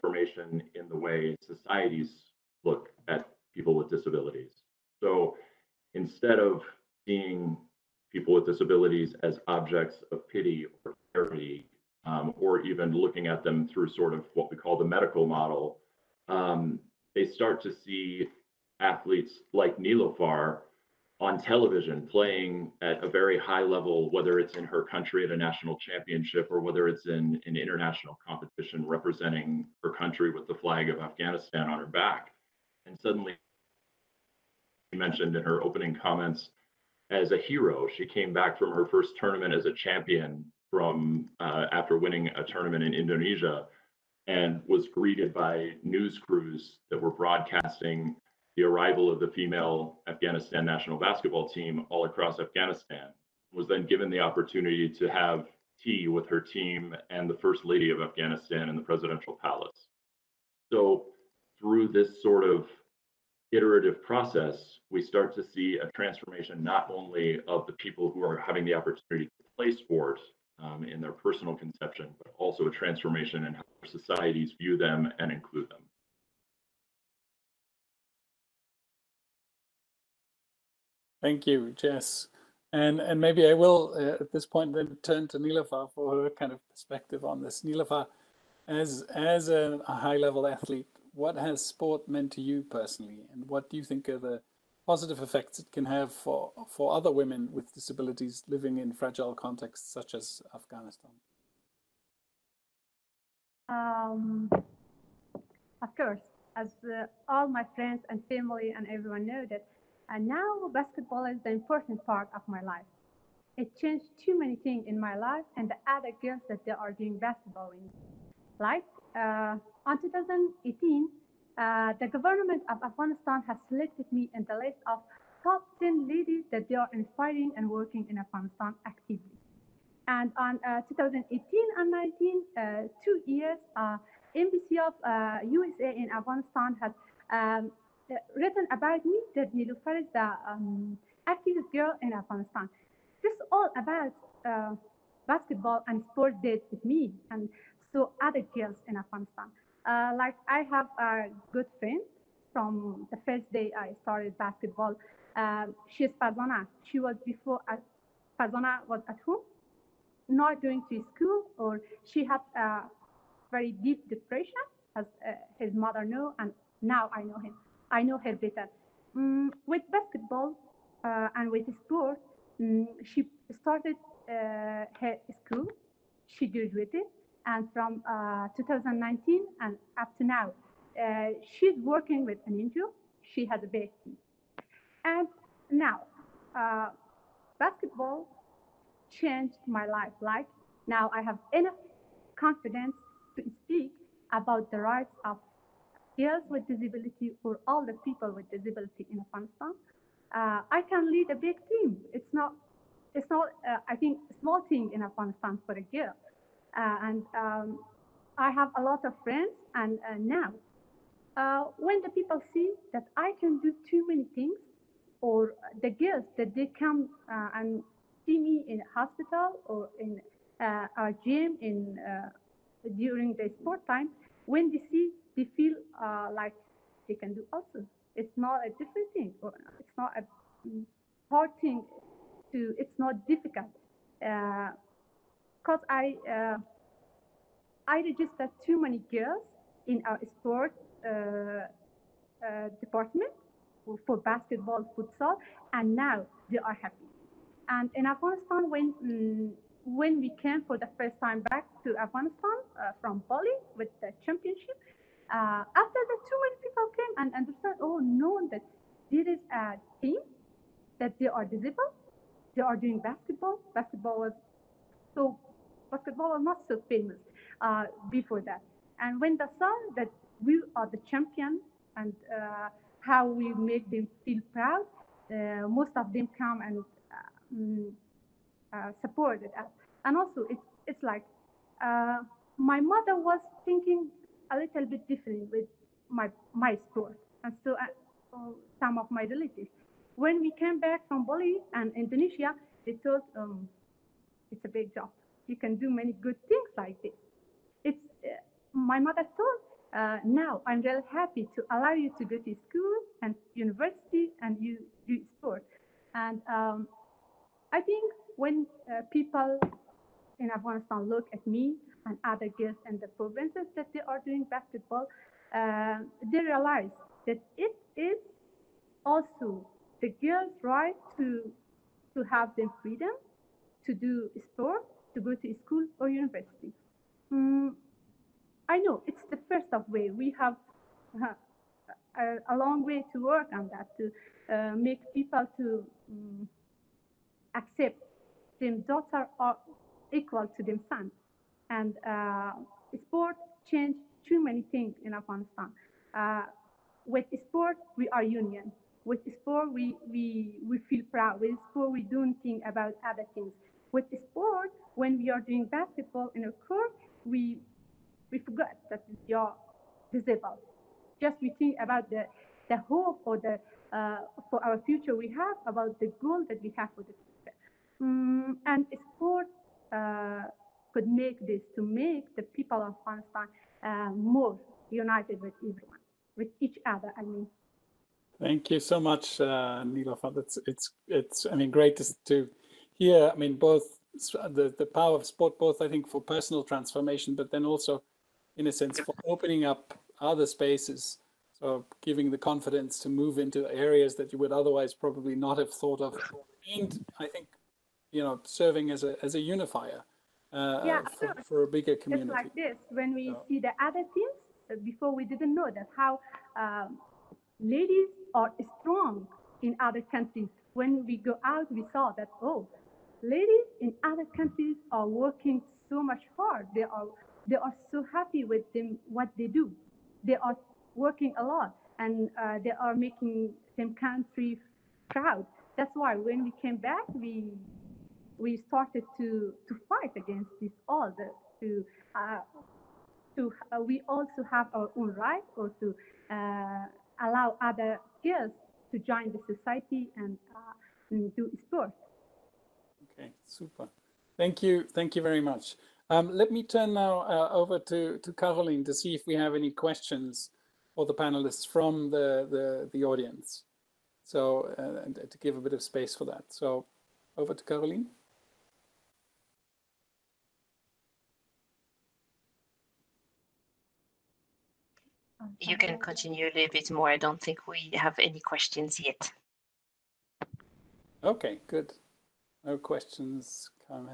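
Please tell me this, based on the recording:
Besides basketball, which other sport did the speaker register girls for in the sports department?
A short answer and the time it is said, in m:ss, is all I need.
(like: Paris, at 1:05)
Futsal, at 4:04.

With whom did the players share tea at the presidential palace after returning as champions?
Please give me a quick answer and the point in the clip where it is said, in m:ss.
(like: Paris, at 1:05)
The First Lady of Afghanistan, at 0:57.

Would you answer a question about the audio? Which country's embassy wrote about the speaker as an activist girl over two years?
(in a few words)
USA.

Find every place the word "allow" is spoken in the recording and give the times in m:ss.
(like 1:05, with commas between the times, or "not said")
5:01, 7:17.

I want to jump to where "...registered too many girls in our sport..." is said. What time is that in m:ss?
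3:58.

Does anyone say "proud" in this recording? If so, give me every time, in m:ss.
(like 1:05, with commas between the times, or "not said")
4:34, 5:51, 7:05.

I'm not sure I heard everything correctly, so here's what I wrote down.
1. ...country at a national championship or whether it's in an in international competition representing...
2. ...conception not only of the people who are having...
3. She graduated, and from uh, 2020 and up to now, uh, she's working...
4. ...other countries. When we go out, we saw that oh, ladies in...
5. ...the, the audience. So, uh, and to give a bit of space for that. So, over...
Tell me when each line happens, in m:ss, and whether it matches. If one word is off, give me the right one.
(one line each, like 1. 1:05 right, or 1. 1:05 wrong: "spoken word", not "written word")
1. 0:24 right
2. 1:05 wrong: "transformation", not "conception"
3. 2:56 wrong: "2019", not "2020"
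4. 6:49 right
5. 7:32 right.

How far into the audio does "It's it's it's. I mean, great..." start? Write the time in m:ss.
6:20.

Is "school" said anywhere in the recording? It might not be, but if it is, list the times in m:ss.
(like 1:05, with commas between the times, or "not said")
2:41, 2:55, 5:02, 5:25.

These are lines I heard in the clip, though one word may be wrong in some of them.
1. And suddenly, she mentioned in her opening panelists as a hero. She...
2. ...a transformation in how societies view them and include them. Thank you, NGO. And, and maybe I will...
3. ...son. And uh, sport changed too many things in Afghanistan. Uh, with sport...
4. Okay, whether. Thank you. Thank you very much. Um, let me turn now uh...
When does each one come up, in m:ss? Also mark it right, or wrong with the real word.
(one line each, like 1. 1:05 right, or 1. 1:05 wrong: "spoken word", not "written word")
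1. 0:32 wrong: "comments", not "panelists"
2. 1:12 wrong: "Jess", not "NGO"
3. 5:40 right
4. 7:23 wrong: "super", not "whether".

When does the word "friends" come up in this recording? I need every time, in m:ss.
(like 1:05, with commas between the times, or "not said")
1:47, 2:31, 3:29.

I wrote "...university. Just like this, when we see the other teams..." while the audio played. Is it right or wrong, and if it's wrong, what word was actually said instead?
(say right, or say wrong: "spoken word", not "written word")
wrong: "community", not "university".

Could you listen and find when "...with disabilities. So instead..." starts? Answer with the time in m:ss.
0:03.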